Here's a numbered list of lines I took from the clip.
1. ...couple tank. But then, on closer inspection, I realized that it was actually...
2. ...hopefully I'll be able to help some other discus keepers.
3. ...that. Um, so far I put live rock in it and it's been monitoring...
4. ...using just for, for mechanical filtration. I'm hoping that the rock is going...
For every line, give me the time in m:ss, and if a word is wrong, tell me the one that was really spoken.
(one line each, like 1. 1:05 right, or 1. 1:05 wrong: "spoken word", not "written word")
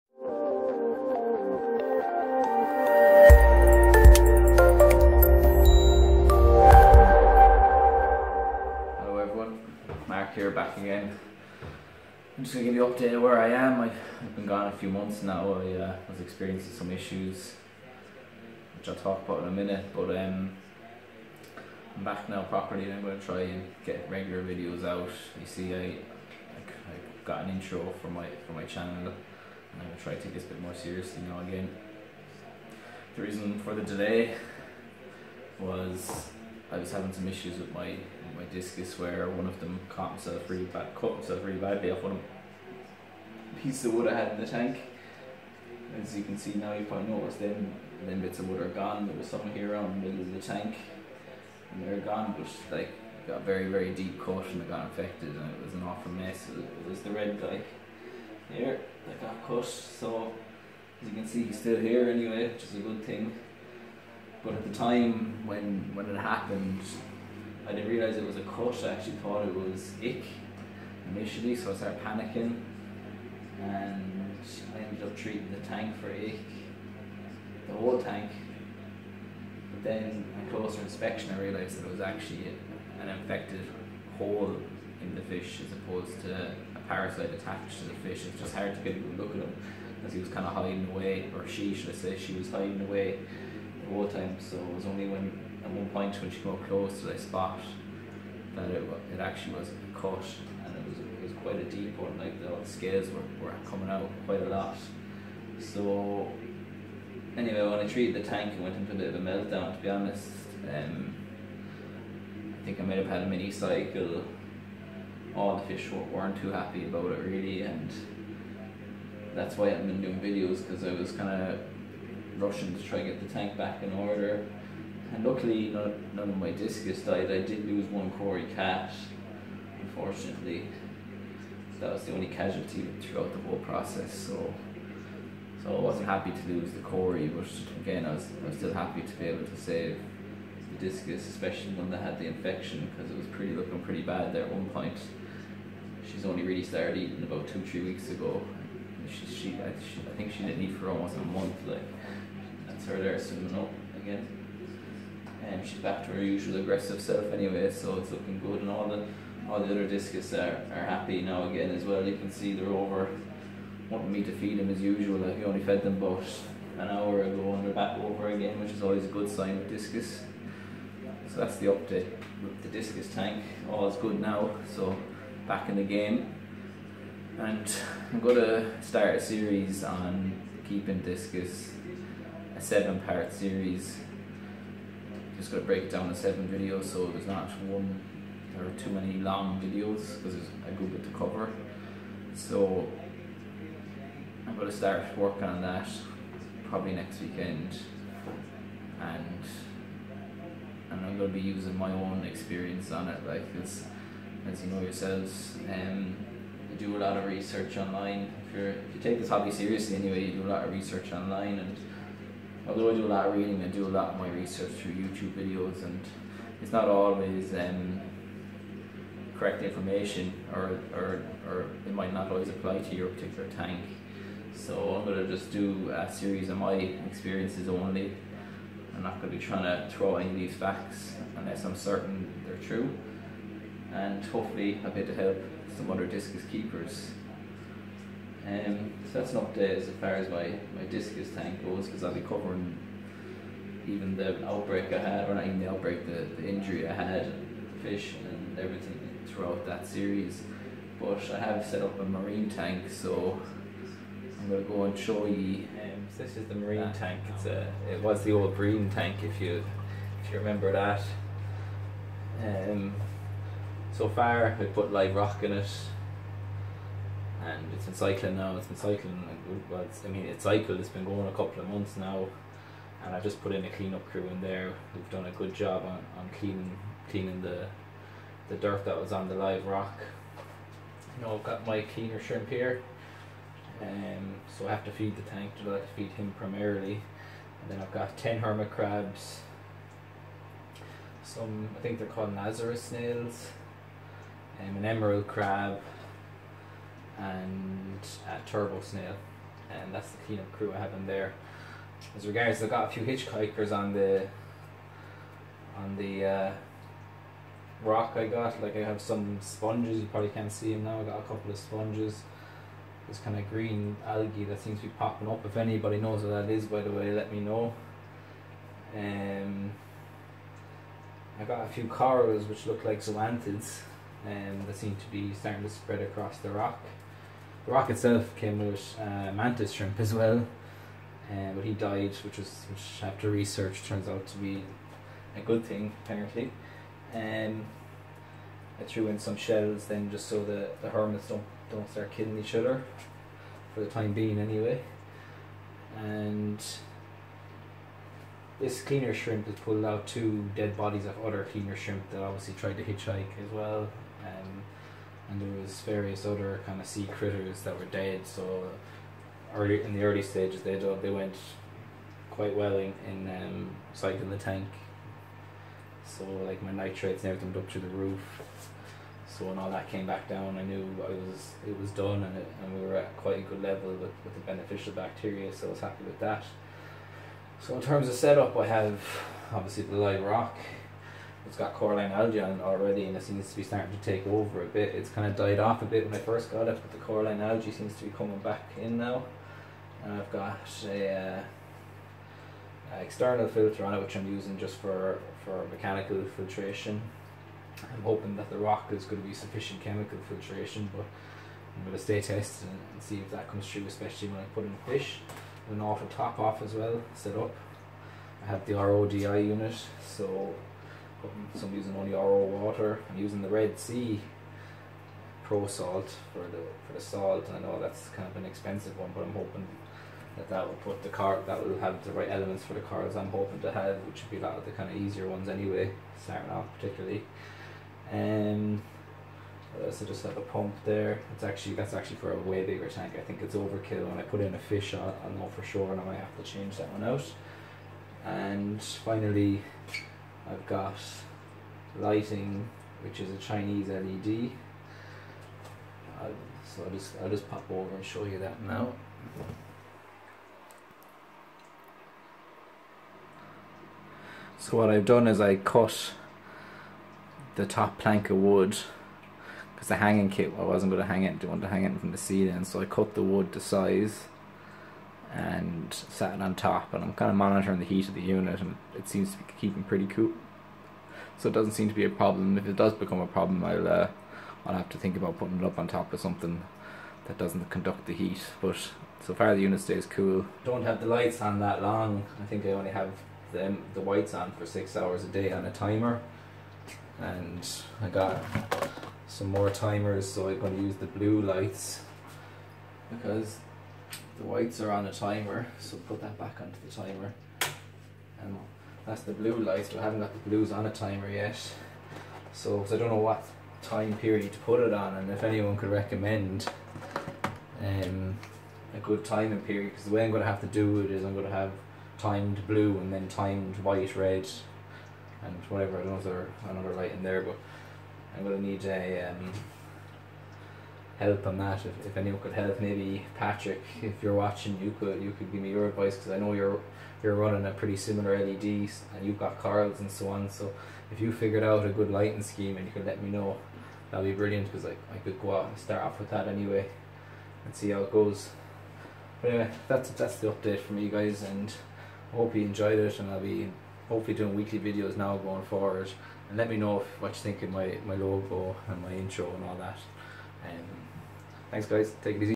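1. 1:17 wrong: "whole", not "couple"
2. 3:54 right
3. 4:20 wrong: "cycling", not "monitoring"
4. 6:34 right.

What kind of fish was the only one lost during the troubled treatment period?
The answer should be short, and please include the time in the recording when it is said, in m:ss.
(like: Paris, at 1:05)
Cory cat, at 2:08.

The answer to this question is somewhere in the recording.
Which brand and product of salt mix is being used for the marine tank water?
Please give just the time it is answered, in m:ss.
6:53.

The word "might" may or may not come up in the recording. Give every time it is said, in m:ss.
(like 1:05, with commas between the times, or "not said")
1:52, 3:41, 7:16.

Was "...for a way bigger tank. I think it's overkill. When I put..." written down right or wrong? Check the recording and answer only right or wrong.
right.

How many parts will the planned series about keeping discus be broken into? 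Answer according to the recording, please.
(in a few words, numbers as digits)
7.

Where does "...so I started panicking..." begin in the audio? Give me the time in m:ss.
1:11.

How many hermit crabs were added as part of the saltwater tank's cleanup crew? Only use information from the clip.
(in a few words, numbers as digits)
10.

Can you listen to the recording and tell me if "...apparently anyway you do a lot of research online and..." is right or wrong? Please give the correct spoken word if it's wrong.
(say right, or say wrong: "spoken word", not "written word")
wrong: "seriously", not "apparently".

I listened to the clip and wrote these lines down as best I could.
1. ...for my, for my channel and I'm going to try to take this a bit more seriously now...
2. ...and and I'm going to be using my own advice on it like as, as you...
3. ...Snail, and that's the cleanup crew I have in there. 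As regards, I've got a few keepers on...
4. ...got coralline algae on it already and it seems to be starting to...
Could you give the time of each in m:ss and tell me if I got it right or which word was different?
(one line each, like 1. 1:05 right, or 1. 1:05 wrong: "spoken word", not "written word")
1. 0:28 right
2. 3:19 wrong: "experience", not "advice"
3. 4:58 wrong: "hitchhikers", not "keepers"
4. 6:21 right.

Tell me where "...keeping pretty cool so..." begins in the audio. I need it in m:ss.
7:49.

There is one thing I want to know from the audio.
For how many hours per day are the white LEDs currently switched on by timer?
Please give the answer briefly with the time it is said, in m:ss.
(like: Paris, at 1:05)
6, at 8:04.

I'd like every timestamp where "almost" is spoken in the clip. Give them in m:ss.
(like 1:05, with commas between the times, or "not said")
2:30.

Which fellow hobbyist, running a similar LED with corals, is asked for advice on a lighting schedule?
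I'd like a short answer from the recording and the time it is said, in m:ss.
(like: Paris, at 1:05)
Patrick, at 8:43.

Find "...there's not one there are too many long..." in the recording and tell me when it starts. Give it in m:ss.
3:07.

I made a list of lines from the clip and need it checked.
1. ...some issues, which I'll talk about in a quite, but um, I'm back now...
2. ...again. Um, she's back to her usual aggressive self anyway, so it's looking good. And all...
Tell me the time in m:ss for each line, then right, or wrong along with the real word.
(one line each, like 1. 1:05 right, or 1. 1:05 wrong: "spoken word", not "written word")
1. 0:16 wrong: "minute", not "quite"
2. 2:33 right.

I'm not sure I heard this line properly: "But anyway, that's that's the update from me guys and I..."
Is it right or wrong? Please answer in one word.
right.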